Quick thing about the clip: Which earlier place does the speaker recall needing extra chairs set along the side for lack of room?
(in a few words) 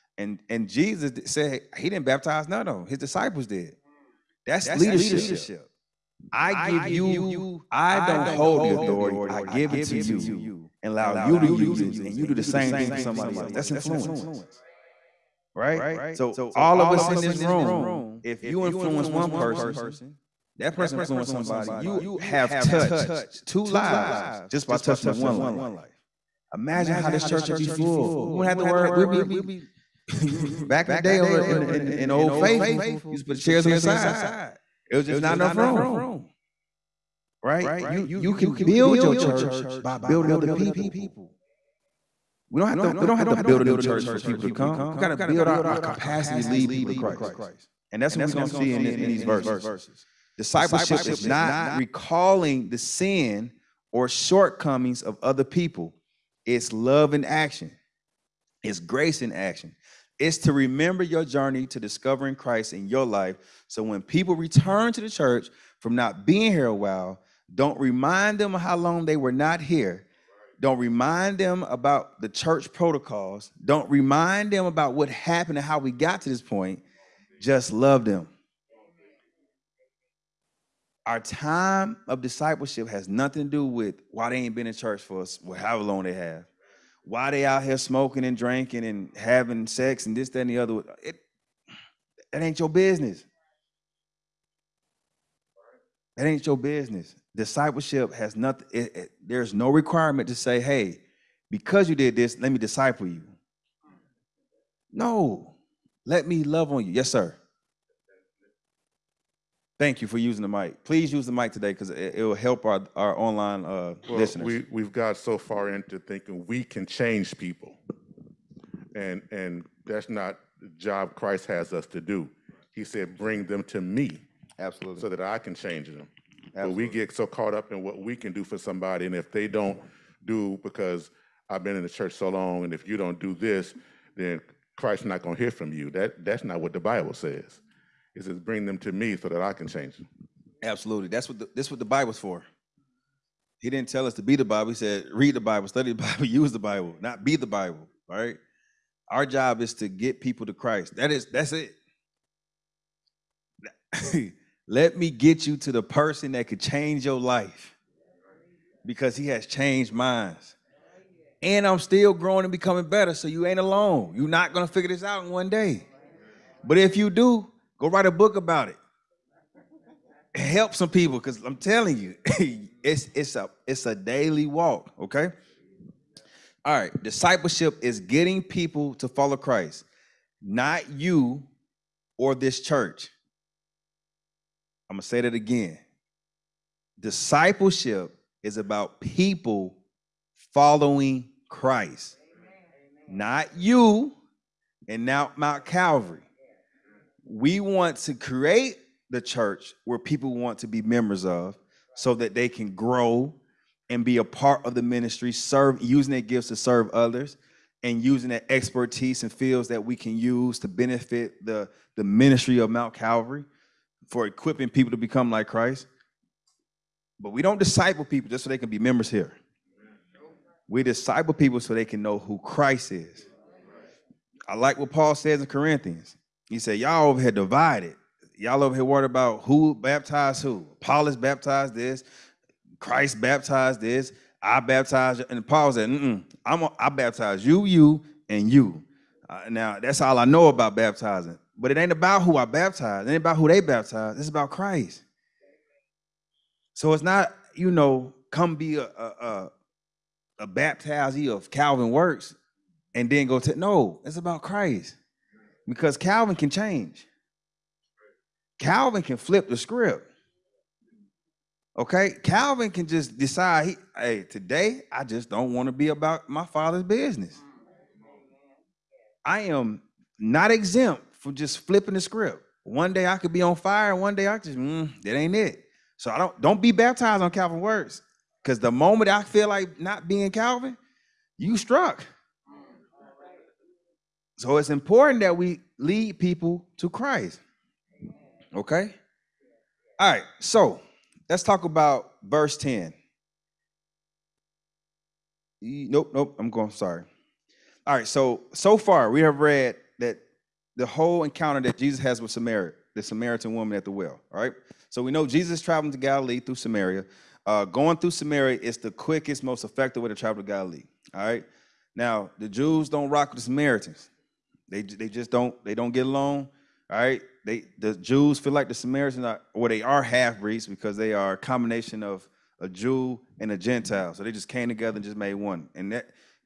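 Old Faithful.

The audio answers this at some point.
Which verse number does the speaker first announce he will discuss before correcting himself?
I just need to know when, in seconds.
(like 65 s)
292 s.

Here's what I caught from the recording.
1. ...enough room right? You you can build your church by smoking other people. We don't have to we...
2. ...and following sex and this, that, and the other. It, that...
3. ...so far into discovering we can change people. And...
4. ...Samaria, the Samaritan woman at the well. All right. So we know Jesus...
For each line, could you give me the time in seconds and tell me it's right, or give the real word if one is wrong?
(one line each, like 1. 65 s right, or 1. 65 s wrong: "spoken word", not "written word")
1. 35 s wrong: "building", not "smoking"
2. 88 s wrong: "having", not "following"
3. 115 s wrong: "thinking", not "discovering"
4. 302 s right.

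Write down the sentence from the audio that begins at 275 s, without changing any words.
So I don't don't be baptized on Calvin Works, because the moment I feel like not being Calvin, you struck.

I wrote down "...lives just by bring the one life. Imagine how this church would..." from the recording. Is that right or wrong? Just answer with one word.
wrong.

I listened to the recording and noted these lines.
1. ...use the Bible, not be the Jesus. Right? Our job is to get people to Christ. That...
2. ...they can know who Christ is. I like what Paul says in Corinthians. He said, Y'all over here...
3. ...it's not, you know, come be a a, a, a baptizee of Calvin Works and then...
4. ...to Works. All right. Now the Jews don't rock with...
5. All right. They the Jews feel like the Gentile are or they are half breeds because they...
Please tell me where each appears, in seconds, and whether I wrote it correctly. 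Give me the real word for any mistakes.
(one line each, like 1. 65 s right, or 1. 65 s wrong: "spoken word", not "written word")
1. 146 s wrong: "Bible", not "Jesus"
2. 221 s right
3. 246 s right
4. 310 s wrong: "Galilee", not "Works"
5. 316 s wrong: "Samaritans", not "Gentile".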